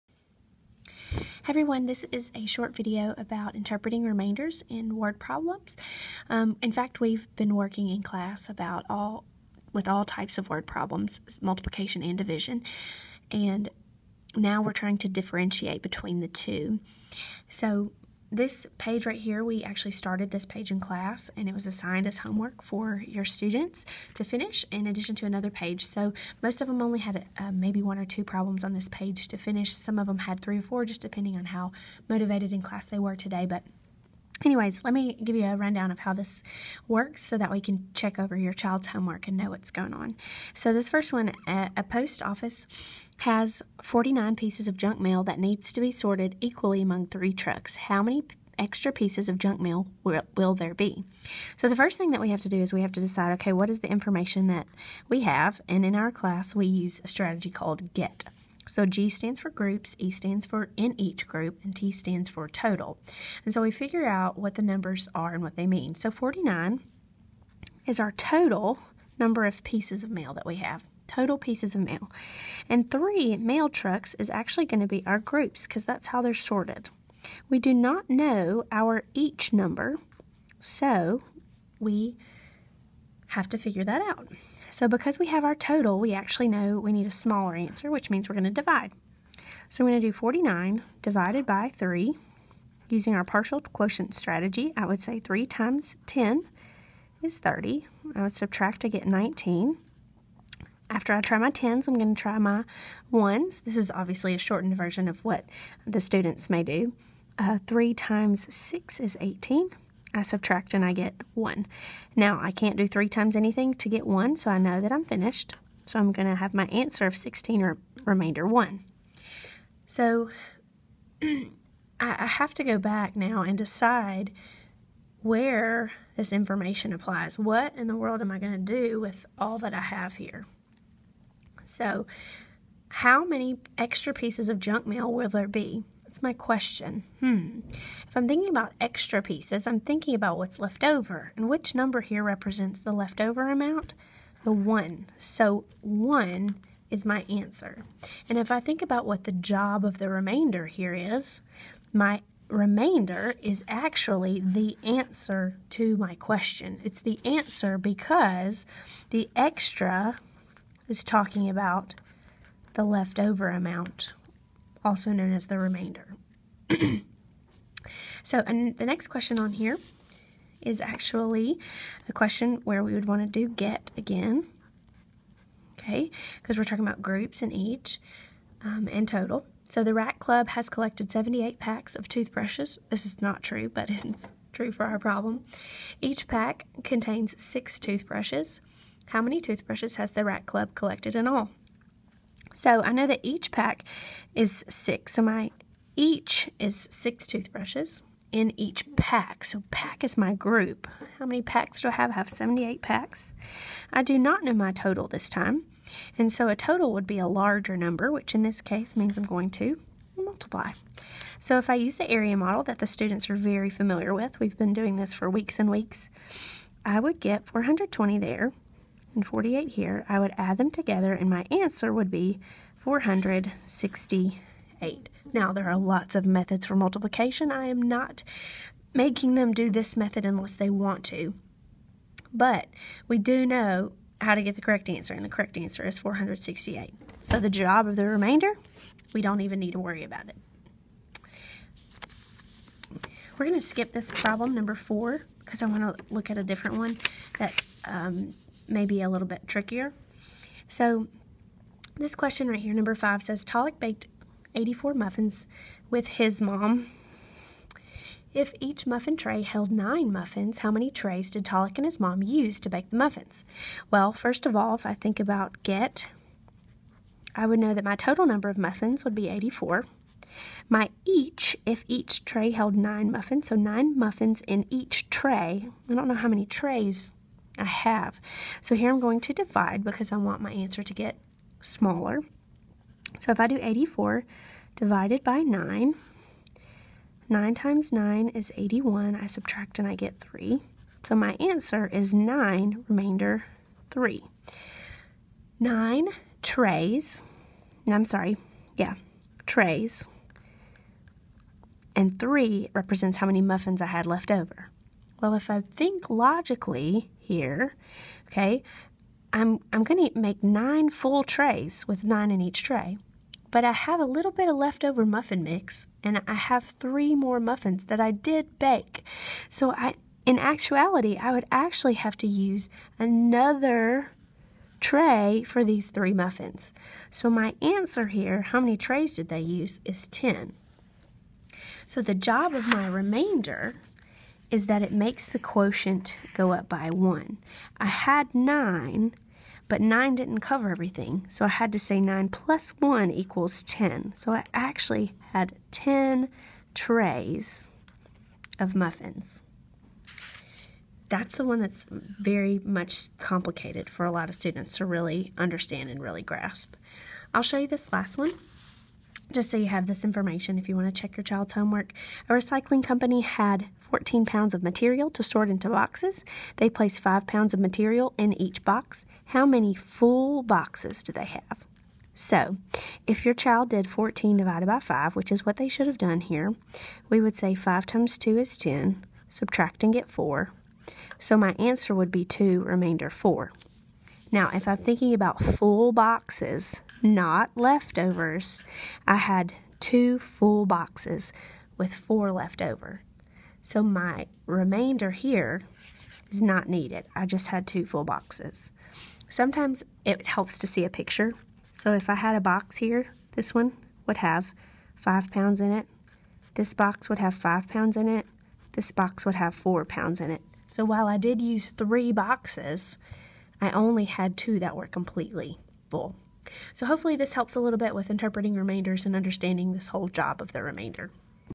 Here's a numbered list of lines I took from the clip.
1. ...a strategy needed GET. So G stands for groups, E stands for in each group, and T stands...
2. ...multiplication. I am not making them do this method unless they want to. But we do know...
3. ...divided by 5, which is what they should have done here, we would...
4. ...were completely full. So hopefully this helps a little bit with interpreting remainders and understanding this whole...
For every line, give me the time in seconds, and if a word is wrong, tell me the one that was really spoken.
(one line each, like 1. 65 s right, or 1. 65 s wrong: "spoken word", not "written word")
1. 57 s wrong: "called", not "needed"
2. 226 s right
3. 374 s right
4. 414 s right.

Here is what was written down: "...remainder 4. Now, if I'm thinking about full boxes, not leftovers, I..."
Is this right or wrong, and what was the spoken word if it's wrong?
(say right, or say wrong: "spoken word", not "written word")
right.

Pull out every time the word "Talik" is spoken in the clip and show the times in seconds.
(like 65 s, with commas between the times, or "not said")
253 s, 261 s.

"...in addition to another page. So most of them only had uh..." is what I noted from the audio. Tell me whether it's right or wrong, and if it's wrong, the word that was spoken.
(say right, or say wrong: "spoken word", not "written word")
right.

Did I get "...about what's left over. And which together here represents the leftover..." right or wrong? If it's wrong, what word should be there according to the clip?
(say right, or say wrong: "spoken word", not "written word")
wrong: "number", not "together".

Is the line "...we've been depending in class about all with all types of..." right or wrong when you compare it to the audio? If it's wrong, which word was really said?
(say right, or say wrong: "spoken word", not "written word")
wrong: "working", not "depending".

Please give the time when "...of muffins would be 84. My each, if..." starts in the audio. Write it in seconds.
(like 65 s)
268 s.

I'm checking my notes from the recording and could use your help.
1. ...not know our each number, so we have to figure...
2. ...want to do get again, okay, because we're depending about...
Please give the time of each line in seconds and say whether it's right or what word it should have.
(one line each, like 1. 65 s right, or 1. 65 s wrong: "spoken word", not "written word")
1. 77 s right
2. 173 s wrong: "talking", not "depending".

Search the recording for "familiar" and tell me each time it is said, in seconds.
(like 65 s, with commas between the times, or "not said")
213 s.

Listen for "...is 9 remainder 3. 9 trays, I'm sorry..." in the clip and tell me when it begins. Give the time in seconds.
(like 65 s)
291 s.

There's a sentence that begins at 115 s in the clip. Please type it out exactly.
So I'm going to have my answer of 16 or remainder 1.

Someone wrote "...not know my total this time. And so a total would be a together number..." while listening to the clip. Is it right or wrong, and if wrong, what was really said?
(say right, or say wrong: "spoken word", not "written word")
wrong: "larger", not "together".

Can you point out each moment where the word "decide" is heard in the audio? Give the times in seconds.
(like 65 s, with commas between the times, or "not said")
52 s, 123 s.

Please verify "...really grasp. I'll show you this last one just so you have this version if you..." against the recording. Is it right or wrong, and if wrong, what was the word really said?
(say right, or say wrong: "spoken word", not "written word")
wrong: "information", not "version".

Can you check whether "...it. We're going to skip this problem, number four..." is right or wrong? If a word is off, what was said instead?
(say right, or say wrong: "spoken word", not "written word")
right.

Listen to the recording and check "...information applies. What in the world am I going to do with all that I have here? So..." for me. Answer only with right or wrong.
right.